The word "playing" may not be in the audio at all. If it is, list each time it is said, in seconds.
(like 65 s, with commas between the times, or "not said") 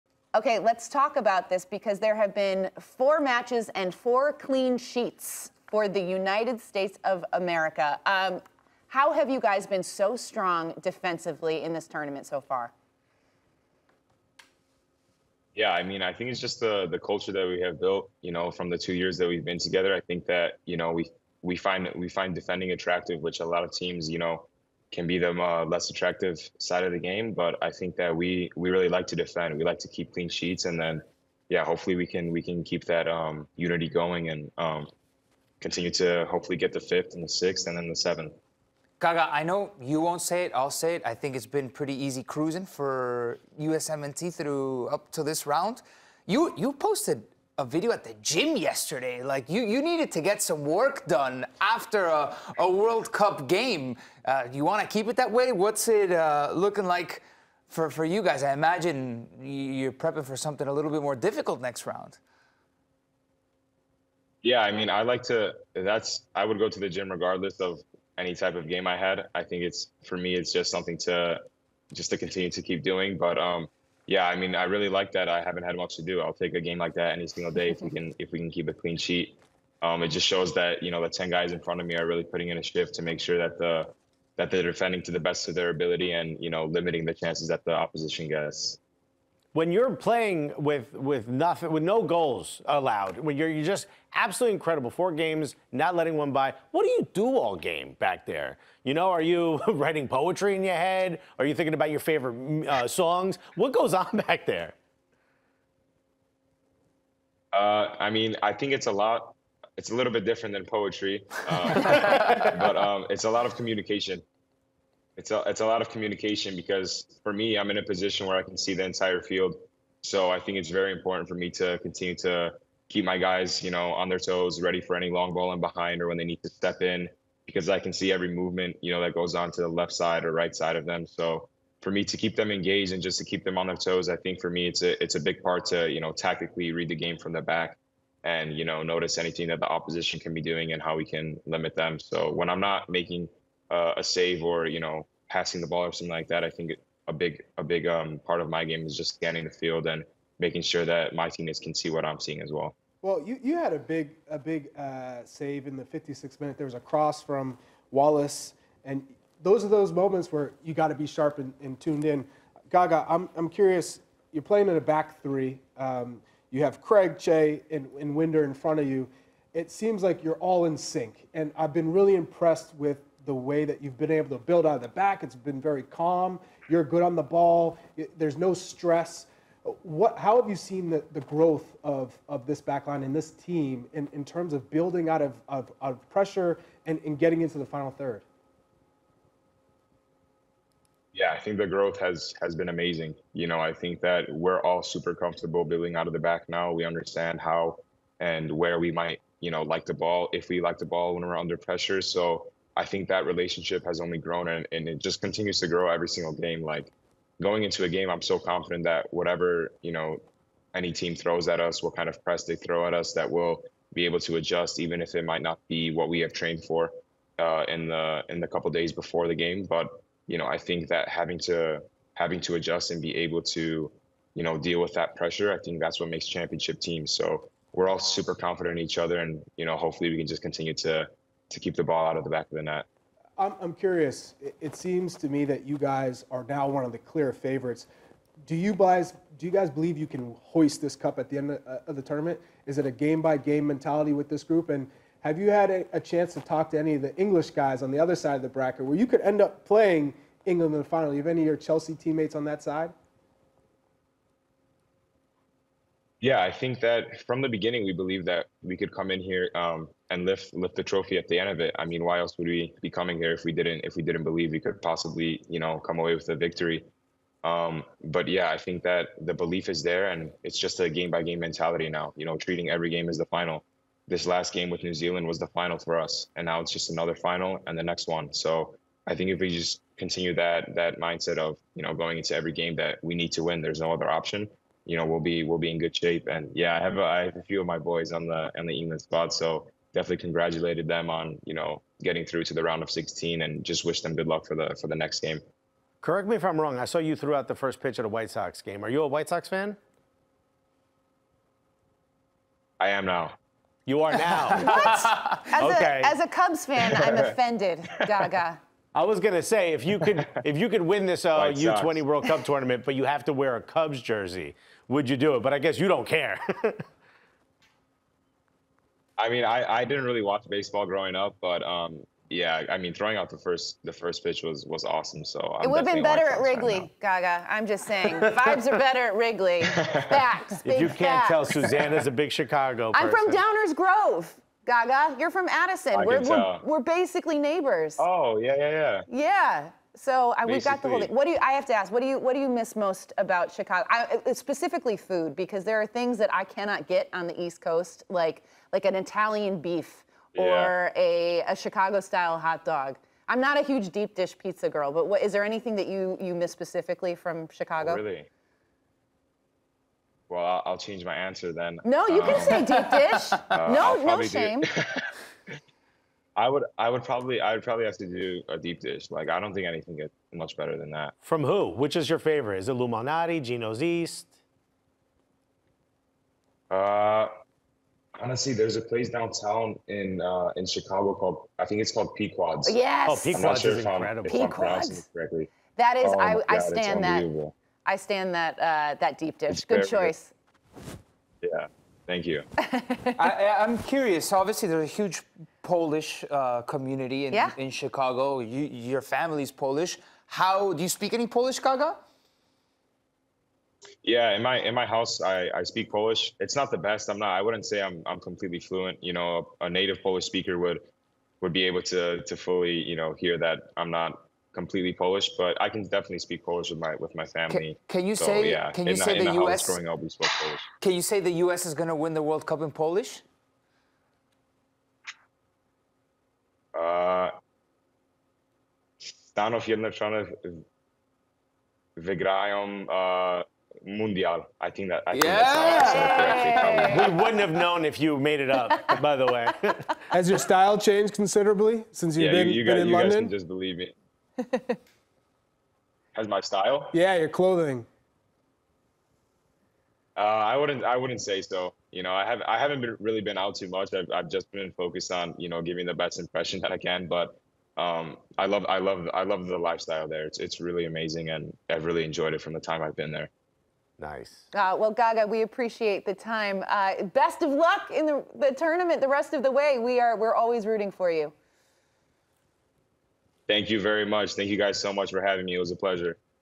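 89 s, 164 s, 249 s.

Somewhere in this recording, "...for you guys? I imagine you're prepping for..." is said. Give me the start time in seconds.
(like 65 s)
57 s.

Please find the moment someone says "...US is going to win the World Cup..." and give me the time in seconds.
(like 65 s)
421 s.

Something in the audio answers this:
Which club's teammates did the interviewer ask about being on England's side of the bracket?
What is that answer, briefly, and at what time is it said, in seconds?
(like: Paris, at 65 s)
Chelsea, at 251 s.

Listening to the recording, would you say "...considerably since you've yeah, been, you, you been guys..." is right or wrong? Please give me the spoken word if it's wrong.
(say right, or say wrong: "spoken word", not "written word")
right.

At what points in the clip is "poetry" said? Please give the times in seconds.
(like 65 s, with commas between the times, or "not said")
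100 s, 110 s.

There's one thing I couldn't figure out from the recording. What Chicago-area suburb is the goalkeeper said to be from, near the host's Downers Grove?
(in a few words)
Addison.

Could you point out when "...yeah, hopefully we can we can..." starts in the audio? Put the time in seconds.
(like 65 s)
31 s.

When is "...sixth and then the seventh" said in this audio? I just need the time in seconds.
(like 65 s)
37 s.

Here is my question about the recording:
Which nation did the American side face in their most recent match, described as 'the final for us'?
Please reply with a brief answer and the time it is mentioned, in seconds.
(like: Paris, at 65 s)
New Zealand, at 274 s.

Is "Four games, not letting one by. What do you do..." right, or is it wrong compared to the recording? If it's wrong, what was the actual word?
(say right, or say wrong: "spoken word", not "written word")
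right.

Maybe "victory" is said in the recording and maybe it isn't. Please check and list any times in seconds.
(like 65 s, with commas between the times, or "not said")
266 s.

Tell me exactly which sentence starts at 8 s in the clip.
Um, how have you guys been so strong defensively in this tournament so far?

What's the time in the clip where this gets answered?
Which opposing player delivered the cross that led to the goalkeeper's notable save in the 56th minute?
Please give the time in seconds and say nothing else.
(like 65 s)
157 s.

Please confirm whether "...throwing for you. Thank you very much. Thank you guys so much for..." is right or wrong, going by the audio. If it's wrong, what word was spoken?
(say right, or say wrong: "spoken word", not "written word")
wrong: "rooting", not "throwing".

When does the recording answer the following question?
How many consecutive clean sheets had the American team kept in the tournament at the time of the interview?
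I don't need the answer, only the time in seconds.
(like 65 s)
3 s.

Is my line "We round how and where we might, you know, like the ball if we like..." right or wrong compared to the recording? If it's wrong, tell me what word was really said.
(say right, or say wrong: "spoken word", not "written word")
wrong: "understand", not "round".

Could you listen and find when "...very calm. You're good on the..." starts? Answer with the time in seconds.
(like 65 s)
175 s.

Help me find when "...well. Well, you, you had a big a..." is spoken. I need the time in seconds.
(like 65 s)
152 s.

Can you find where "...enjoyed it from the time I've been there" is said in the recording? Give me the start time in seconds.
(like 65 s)
462 s.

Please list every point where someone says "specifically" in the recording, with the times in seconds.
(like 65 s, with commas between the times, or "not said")
344 s, 356 s.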